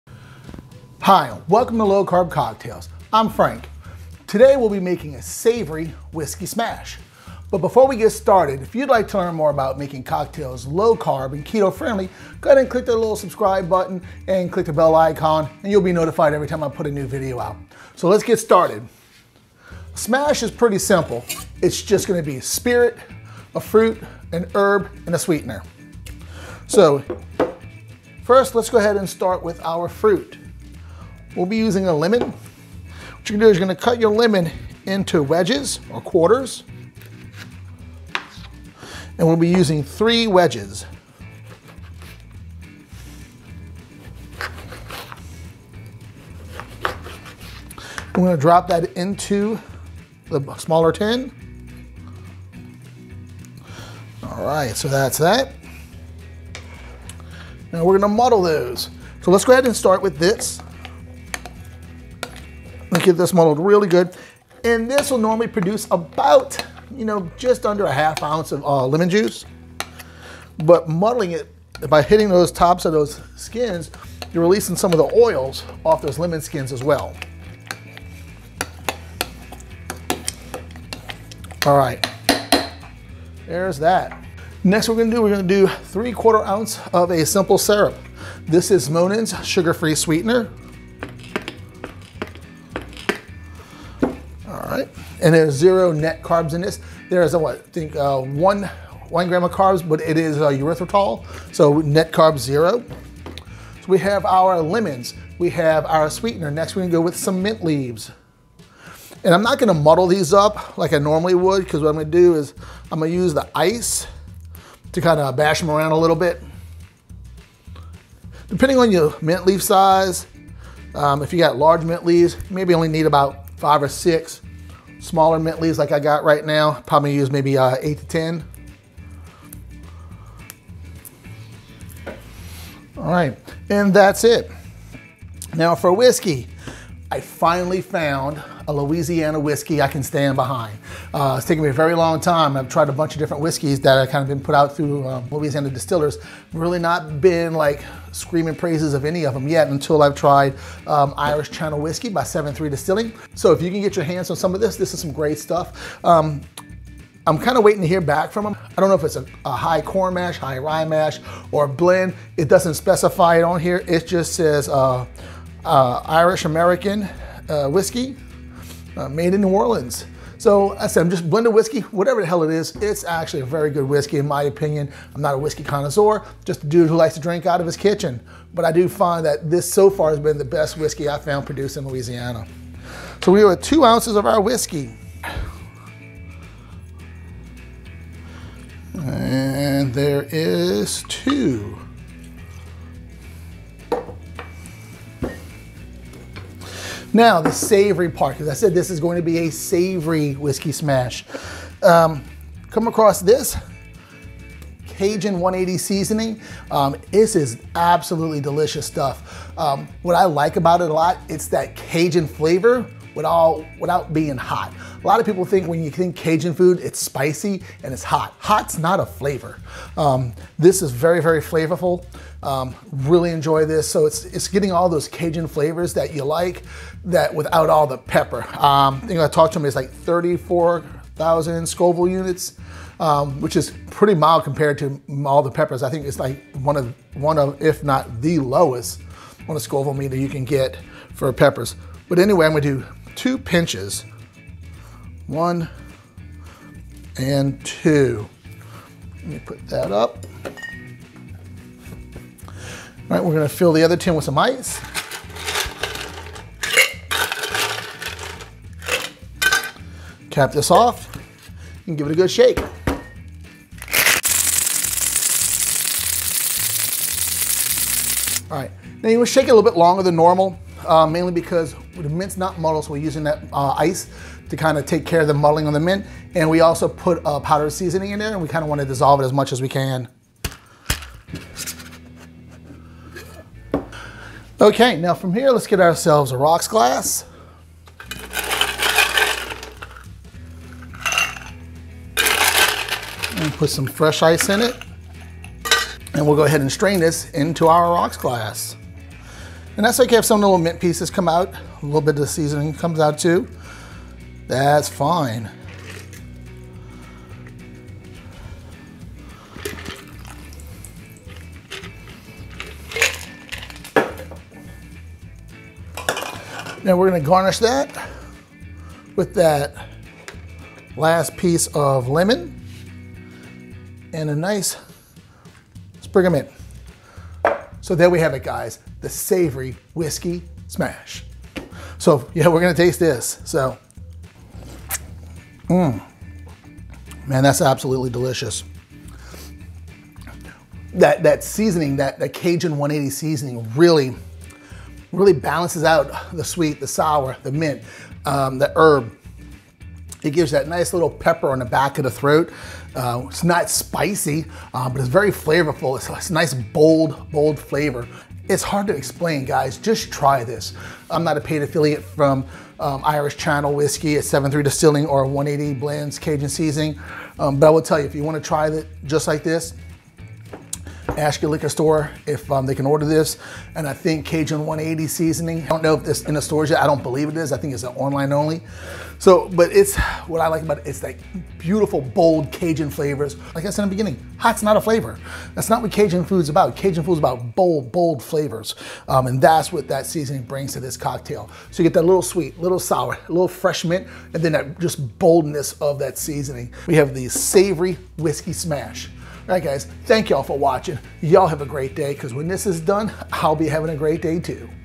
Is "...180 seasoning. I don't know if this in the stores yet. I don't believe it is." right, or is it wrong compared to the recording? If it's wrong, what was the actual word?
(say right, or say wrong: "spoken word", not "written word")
right.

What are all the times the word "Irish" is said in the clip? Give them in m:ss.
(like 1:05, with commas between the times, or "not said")
2:31, 2:46, 6:03.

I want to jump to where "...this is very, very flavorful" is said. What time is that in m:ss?
3:40.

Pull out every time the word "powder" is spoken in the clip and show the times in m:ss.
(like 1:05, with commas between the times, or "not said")
4:37.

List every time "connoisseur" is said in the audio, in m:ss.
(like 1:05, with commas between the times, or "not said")
2:55.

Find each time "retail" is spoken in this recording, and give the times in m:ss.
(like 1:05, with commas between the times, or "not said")
not said.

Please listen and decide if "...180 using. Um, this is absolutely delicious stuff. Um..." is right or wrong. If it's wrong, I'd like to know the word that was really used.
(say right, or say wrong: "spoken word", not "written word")
wrong: "seasoning", not "using".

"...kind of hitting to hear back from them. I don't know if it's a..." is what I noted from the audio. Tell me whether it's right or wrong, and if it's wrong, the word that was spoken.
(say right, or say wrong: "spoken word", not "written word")
wrong: "waiting", not "hitting".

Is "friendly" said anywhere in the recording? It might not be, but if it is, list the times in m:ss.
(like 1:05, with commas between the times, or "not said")
0:11.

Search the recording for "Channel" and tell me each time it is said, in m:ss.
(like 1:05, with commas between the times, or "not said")
2:31, 6:03.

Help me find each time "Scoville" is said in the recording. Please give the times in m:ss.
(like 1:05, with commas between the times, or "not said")
3:51, 3:59.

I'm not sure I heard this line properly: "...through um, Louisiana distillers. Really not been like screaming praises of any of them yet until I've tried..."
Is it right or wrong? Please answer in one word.
right.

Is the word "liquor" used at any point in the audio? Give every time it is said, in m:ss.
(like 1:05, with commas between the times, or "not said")
6:11.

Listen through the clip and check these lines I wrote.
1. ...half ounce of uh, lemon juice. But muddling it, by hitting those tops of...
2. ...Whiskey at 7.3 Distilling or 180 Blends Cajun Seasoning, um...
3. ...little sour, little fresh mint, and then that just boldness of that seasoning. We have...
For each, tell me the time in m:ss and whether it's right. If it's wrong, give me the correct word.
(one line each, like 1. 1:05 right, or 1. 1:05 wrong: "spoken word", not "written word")
1. 1:07 right
2. 6:03 right
3. 6:32 right.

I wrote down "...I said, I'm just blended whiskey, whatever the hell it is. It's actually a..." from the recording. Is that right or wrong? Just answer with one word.
right.